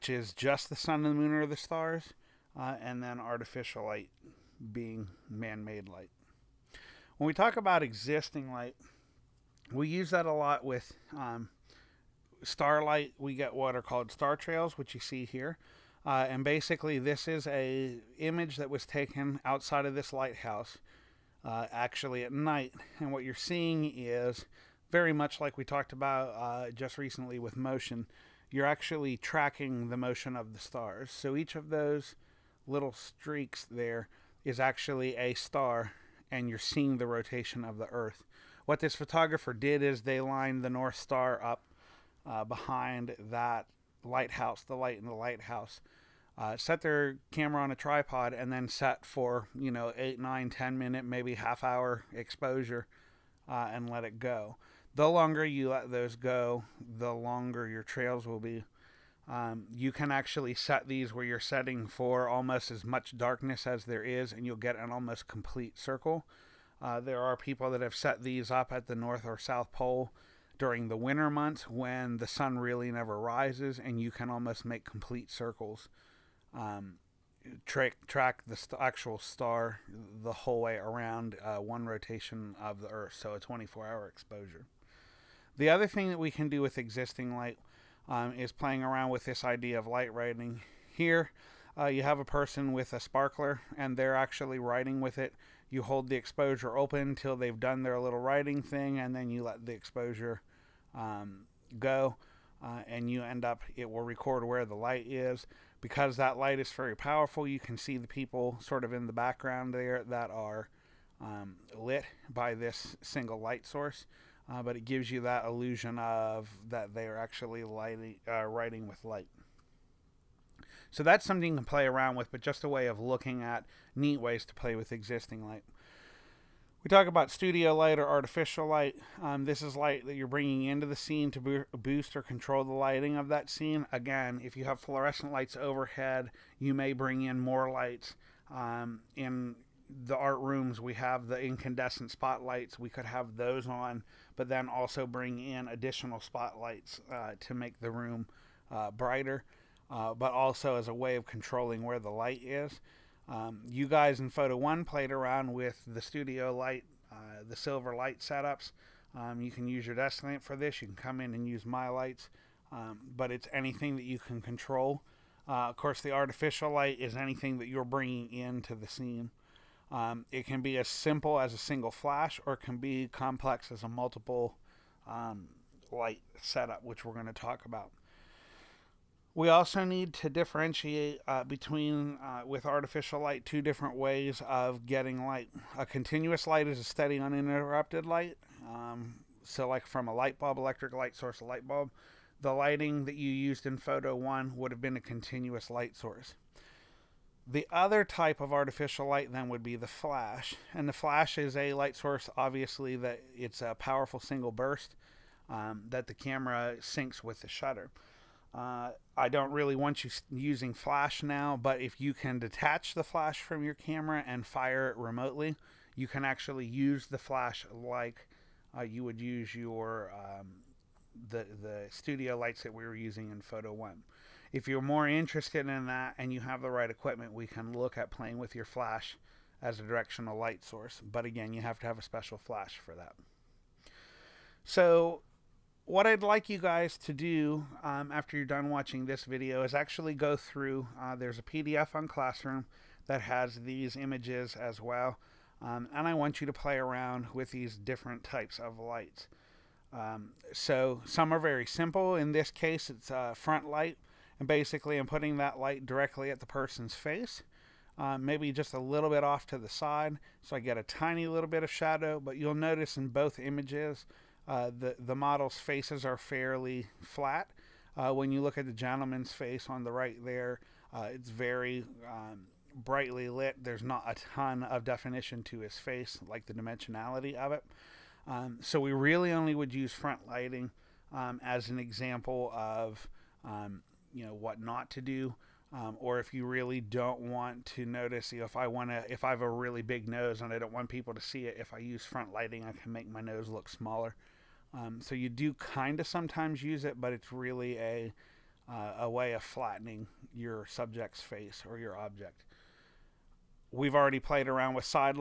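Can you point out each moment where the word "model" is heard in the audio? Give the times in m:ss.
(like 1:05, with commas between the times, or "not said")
4:25.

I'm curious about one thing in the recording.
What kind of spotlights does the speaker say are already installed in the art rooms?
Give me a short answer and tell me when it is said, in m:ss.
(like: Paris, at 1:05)
incandescent spotlights, at 2:21.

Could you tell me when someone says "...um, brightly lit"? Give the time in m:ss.
4:32.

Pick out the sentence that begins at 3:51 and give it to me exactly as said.
But again, you have to have a special flash for that.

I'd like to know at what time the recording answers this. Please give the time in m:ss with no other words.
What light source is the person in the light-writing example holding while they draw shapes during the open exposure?
1:32.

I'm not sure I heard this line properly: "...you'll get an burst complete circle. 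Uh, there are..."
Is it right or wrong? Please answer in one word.
wrong.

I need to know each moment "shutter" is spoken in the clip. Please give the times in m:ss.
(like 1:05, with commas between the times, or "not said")
3:27.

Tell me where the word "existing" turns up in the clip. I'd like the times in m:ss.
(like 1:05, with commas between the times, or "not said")
0:07, 1:26, 2:04.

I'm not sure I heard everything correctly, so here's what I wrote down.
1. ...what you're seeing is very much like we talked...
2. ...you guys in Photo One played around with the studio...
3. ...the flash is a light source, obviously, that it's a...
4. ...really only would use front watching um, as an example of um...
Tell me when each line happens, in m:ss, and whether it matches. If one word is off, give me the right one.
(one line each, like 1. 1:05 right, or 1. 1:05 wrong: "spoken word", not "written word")
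1. 0:23 right
2. 2:33 right
3. 3:20 right
4. 4:38 wrong: "lighting", not "watching".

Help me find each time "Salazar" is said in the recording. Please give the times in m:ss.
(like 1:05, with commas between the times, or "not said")
not said.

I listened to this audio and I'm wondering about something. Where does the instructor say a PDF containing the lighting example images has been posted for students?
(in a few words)
Classroom.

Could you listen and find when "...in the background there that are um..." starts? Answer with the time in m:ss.
1:48.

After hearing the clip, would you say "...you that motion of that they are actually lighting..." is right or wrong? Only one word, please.
wrong.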